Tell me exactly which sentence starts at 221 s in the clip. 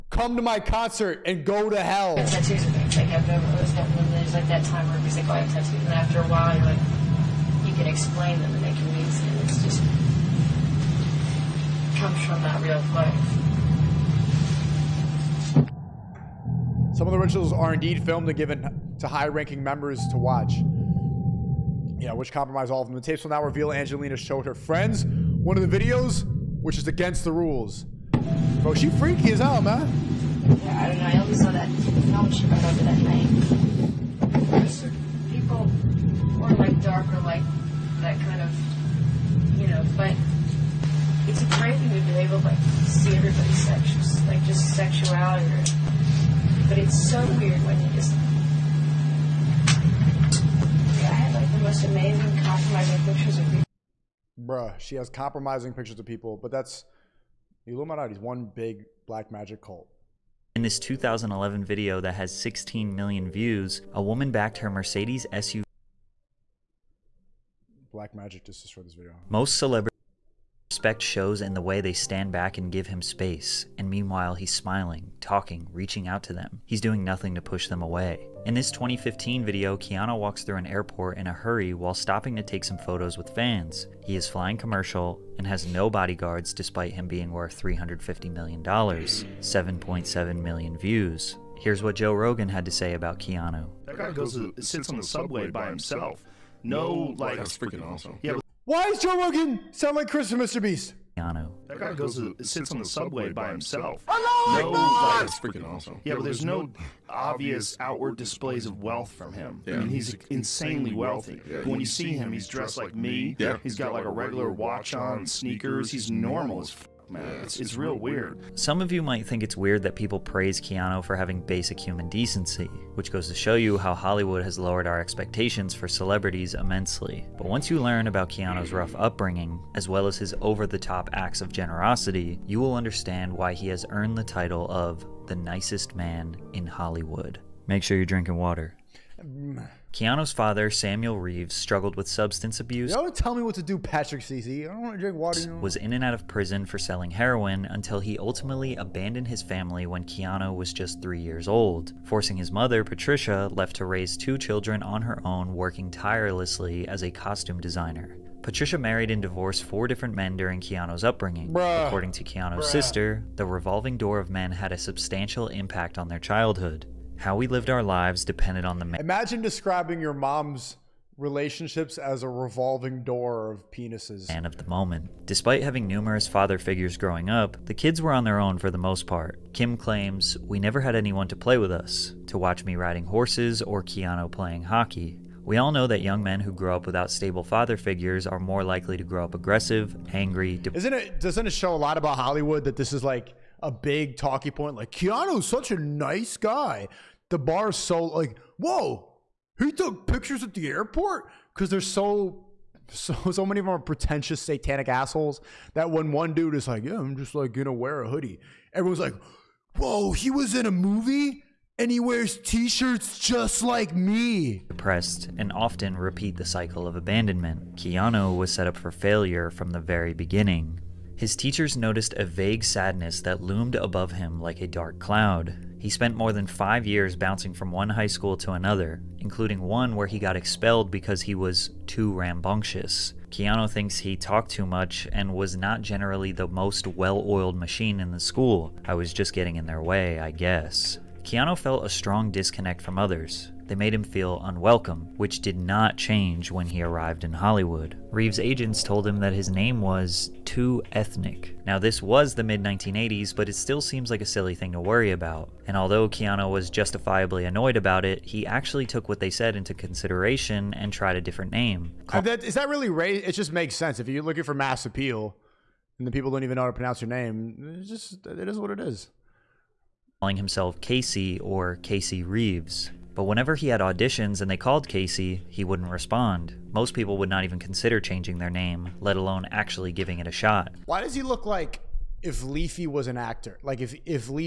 His teachers noticed a vague sadness that loomed above him like a dark cloud.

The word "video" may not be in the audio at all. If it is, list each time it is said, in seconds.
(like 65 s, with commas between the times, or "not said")
25 s, 61 s, 68 s, 79 s.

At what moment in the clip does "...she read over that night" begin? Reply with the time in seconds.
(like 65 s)
32 s.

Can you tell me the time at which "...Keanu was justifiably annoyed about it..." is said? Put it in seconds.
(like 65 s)
256 s.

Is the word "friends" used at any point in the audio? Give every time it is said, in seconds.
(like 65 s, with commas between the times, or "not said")
24 s.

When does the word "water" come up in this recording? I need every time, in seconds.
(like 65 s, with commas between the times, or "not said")
138 s, 145 s.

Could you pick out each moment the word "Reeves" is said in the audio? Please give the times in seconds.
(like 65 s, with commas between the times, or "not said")
141 s, 248 s, 272 s.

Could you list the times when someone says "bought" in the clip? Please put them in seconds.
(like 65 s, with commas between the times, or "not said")
not said.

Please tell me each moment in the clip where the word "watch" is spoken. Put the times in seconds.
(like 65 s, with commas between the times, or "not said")
20 s, 114 s, 182 s.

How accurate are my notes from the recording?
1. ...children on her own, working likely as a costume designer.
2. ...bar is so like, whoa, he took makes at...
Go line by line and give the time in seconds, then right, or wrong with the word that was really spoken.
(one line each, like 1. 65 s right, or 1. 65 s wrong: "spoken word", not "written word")
1. 154 s wrong: "tirelessly", not "likely"
2. 197 s wrong: "pictures", not "makes".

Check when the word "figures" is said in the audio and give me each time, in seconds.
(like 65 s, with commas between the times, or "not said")
176 s, 187 s.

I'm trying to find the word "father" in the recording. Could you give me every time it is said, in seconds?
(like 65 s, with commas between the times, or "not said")
140 s, 176 s, 187 s.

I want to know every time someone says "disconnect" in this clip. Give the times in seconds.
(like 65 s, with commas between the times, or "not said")
242 s.